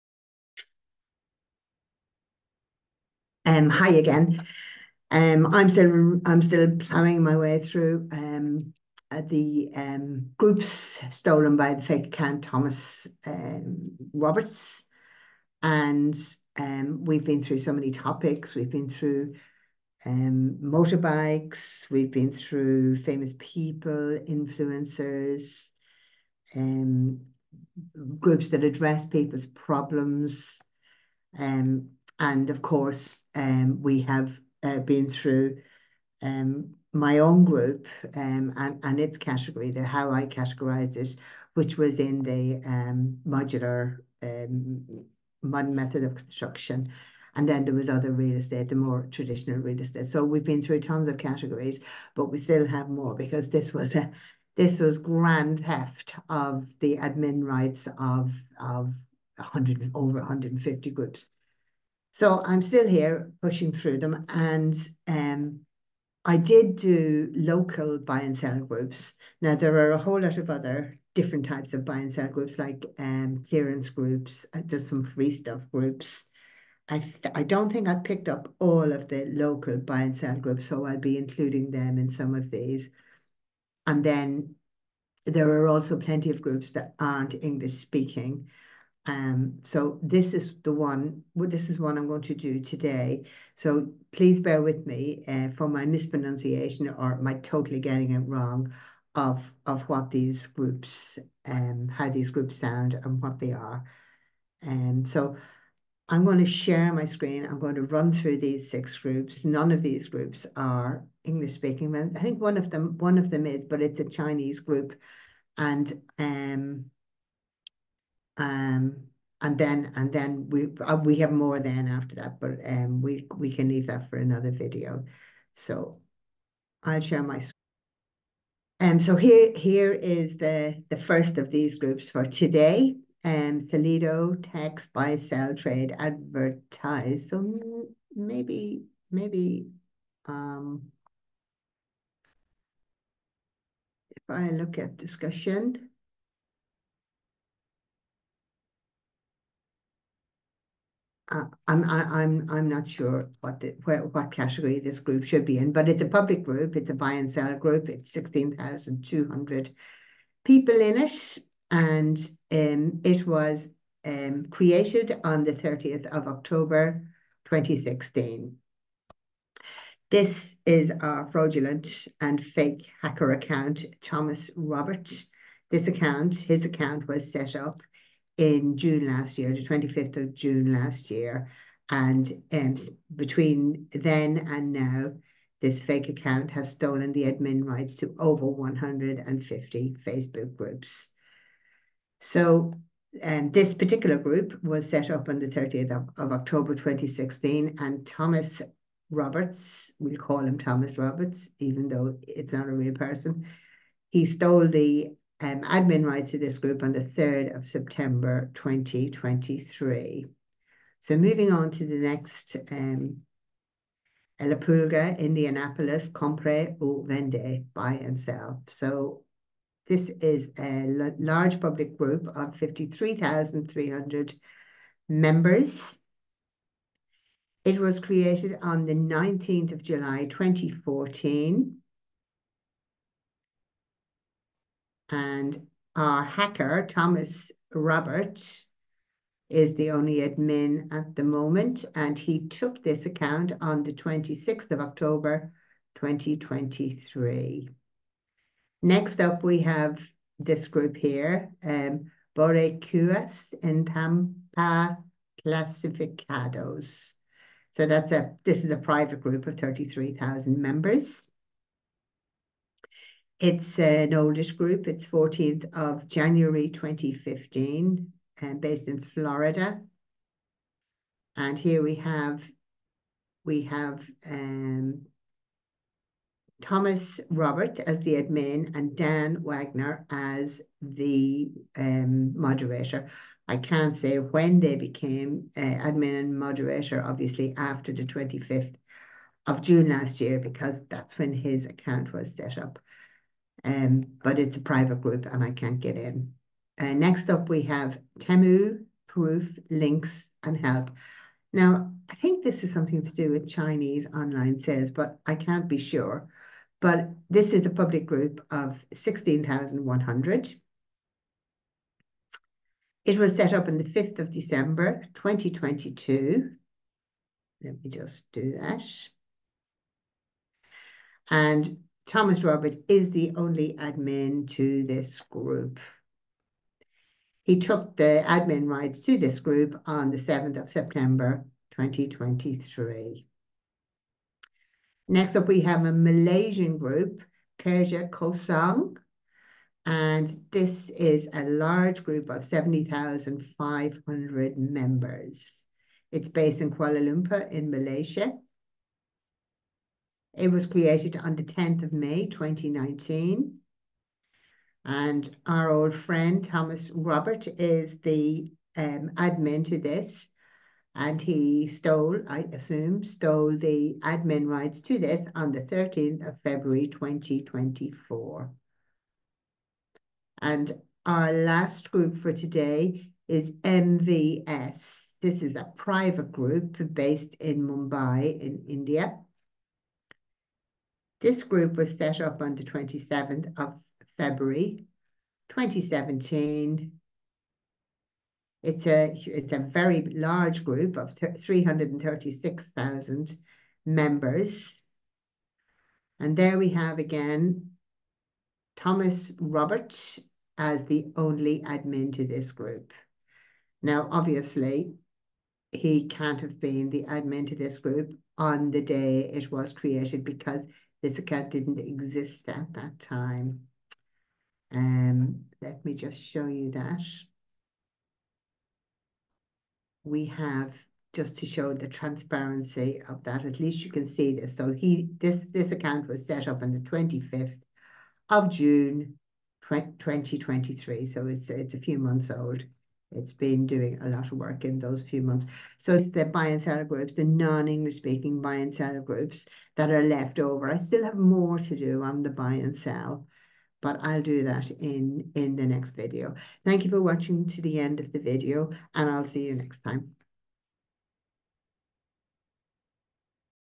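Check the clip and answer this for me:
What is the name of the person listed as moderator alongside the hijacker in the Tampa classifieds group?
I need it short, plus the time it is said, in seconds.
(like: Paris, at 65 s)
Dan Wagner, at 278 s.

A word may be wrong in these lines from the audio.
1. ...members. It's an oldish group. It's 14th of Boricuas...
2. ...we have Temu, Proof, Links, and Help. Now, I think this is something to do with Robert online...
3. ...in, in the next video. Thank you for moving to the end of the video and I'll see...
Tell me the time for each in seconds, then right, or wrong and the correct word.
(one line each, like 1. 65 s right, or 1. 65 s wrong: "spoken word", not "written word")
1. 260 s wrong: "January", not "Boricuas"
2. 297 s wrong: "Chinese", not "Robert"
3. 444 s wrong: "watching", not "moving".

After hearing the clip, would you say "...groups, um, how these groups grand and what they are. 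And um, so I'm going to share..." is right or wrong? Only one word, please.
wrong.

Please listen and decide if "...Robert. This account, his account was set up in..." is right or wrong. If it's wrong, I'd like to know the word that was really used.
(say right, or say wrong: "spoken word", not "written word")
right.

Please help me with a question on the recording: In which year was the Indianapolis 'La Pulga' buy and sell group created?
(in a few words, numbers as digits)
2014.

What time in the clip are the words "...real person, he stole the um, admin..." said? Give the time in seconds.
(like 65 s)
202 s.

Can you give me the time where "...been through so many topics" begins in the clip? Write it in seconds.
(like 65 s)
17 s.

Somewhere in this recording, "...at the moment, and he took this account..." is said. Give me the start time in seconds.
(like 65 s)
240 s.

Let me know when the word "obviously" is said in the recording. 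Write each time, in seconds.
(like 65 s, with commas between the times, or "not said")
287 s, 404 s.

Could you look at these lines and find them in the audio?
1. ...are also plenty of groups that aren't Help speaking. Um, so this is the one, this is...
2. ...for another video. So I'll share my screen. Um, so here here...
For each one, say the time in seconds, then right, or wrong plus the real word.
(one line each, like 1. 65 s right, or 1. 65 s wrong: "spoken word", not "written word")
1. 85 s wrong: "English", not "Help"
2. 124 s right.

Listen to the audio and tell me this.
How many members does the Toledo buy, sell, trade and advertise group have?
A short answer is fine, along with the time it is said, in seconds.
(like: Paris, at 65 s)
16,200, at 158 s.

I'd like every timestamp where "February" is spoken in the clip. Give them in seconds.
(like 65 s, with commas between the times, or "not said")
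366 s, 384 s.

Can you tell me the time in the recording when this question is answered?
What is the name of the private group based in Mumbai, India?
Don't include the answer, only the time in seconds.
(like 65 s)
373 s.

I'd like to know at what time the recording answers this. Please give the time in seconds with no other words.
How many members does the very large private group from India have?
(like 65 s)
391 s.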